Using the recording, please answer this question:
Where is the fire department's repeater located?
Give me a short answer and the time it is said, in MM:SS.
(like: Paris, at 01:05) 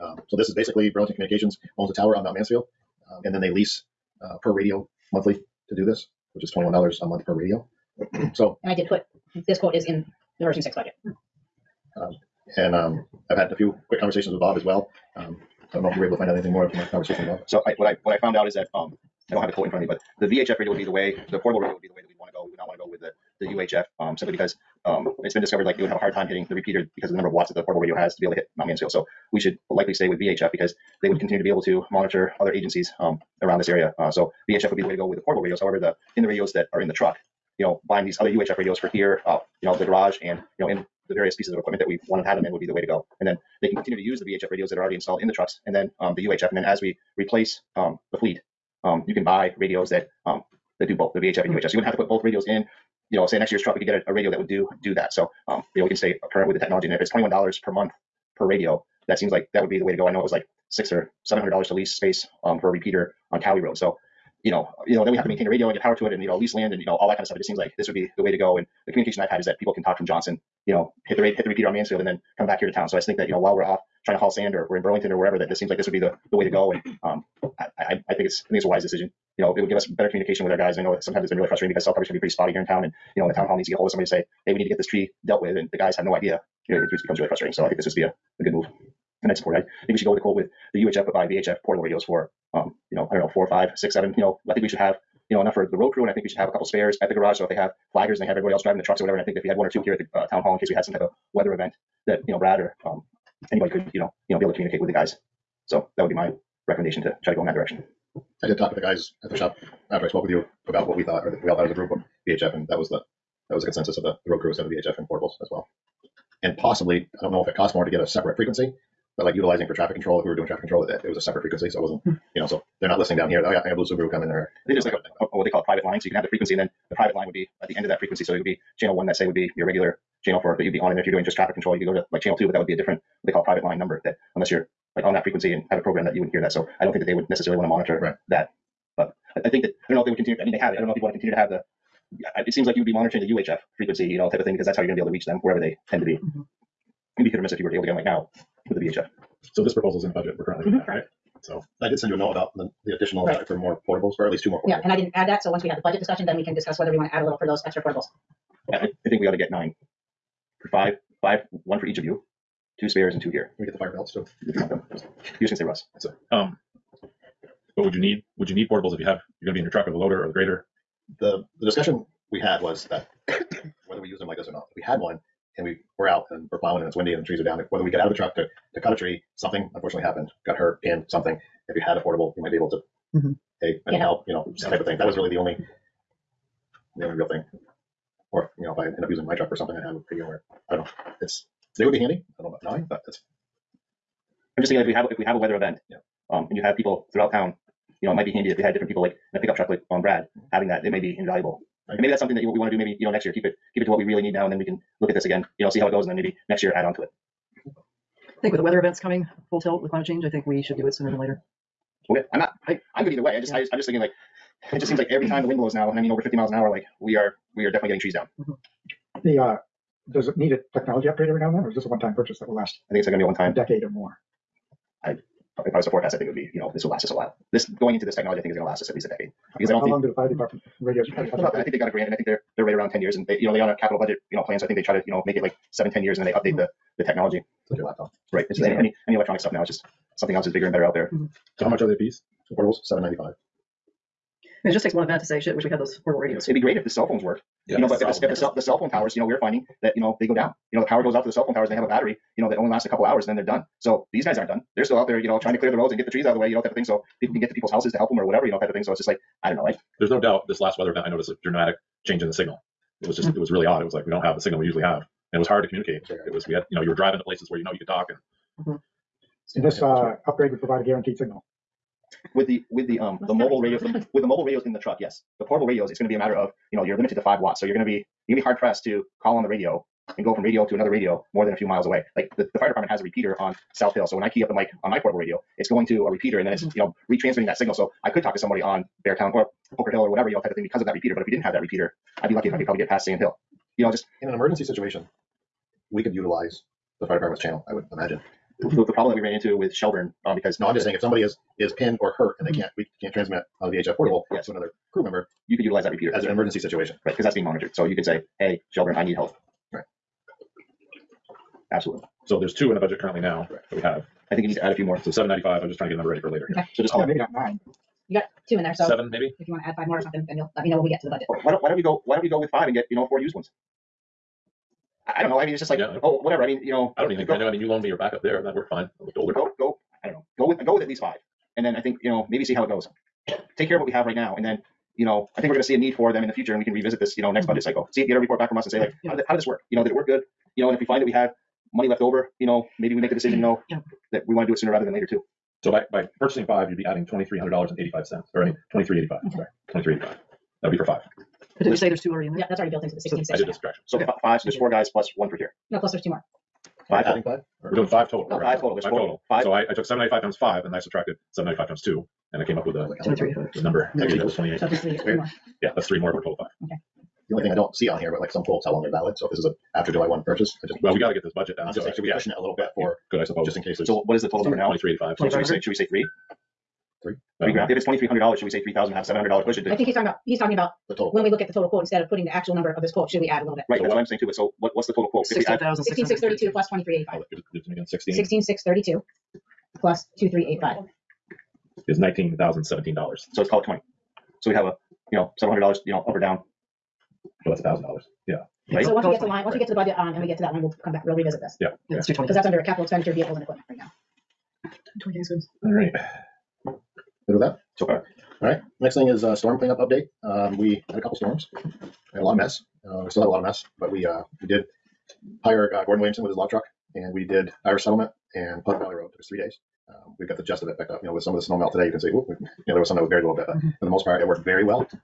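South Hill, at 04:43.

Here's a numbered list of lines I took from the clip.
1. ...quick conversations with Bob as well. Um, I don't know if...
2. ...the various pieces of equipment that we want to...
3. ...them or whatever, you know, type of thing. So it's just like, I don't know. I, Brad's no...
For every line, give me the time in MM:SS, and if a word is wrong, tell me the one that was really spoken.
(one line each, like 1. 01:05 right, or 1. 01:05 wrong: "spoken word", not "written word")
1. 00:13 right
2. 00:41 right
3. 04:18 wrong: "There", not "Brad".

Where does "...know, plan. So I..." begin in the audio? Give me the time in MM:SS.
03:54.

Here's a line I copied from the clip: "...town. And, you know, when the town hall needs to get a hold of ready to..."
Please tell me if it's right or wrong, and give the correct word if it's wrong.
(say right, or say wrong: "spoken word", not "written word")
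wrong: "somebody", not "ready".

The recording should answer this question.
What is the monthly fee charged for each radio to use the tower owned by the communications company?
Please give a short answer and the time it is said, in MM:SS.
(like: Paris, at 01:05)
$21, at 00:06.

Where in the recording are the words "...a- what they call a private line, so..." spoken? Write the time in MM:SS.
02:05.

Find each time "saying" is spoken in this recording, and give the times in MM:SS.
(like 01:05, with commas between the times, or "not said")
05:00, 06:11, 06:24.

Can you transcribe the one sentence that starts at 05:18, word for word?
you got two in there, so Seven, maybe?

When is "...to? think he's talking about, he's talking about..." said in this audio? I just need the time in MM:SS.
06:19.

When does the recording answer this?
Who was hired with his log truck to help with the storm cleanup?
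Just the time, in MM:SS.
06:55.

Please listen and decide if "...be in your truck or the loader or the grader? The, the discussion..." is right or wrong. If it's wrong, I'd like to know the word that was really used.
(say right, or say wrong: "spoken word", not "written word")
right.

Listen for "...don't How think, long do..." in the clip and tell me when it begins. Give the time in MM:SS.
03:49.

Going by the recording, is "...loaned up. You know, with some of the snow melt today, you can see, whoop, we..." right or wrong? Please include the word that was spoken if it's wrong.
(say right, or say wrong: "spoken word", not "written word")
wrong: "picked", not "loaned".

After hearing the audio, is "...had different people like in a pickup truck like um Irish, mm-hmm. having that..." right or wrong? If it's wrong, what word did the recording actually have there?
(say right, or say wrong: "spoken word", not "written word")
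wrong: "Brad", not "Irish".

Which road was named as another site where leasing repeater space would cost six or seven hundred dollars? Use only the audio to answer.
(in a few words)
Cowie Road.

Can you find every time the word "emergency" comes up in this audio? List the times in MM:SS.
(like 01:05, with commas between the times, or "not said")
04:54, 05:06.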